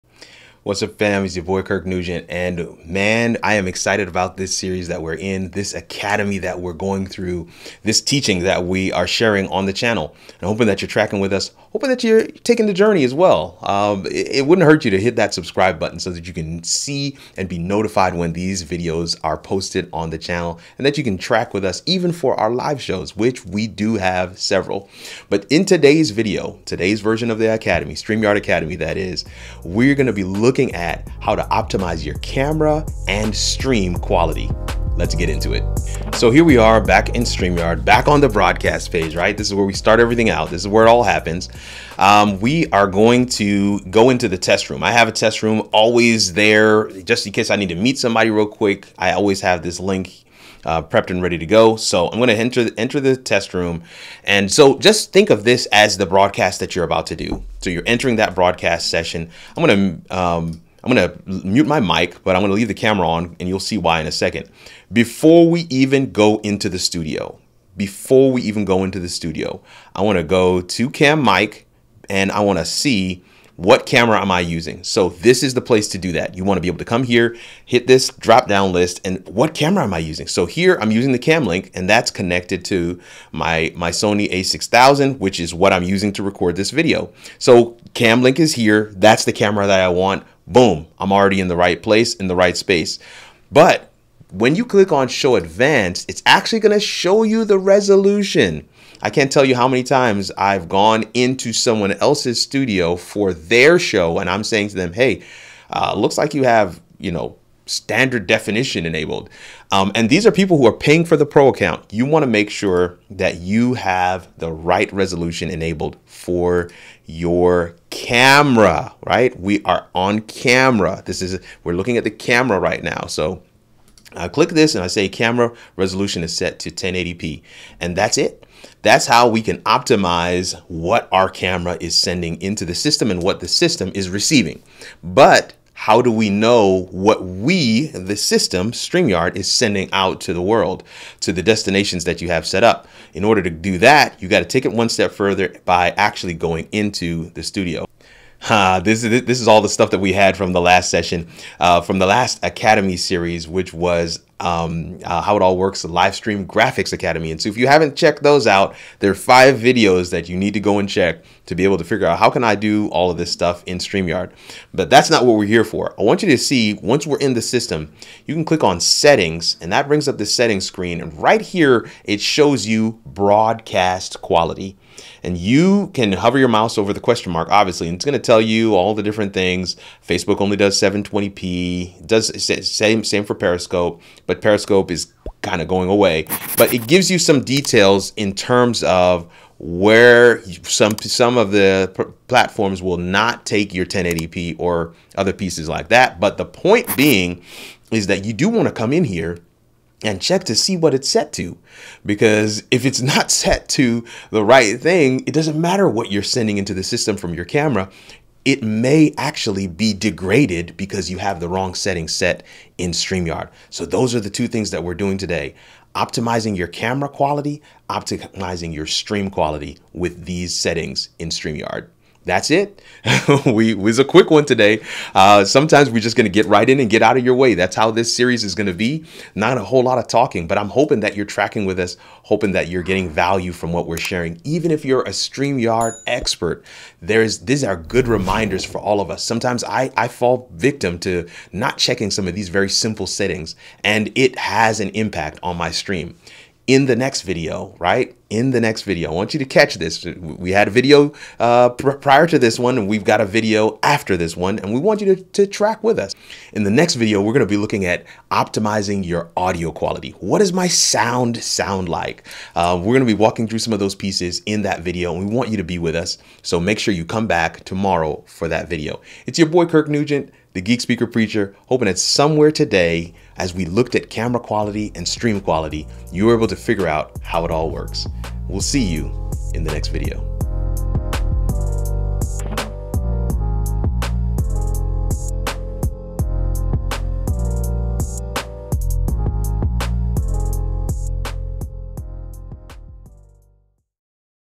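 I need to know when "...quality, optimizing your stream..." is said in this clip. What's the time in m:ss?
3:37.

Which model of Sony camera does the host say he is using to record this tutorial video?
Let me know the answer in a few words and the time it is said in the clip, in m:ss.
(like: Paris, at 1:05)
Sony a6000, at 1:23.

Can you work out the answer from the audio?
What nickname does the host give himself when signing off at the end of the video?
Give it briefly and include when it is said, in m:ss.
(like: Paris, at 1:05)
the Geek Speaker Preacher, at 4:30.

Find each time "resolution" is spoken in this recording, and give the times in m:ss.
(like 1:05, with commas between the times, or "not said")
1:37, 1:54, 2:05.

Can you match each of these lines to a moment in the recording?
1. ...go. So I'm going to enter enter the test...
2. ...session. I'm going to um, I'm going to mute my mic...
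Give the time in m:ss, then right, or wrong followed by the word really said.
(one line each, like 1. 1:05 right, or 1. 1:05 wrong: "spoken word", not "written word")
1. 0:51 right
2. 0:58 right.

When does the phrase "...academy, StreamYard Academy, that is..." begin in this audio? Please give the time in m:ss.
0:27.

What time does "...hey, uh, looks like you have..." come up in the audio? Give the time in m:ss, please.
1:44.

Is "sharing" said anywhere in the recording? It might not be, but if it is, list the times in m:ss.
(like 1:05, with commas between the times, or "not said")
0:09, 3:53.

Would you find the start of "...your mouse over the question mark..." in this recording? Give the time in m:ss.
2:56.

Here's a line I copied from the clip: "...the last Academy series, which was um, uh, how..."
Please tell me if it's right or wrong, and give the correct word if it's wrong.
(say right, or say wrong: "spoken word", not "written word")
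right.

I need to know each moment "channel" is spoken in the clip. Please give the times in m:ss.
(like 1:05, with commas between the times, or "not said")
0:09, 0:20.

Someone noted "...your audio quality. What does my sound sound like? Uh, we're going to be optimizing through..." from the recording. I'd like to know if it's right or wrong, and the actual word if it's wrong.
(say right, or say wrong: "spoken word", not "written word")
wrong: "walking", not "optimizing".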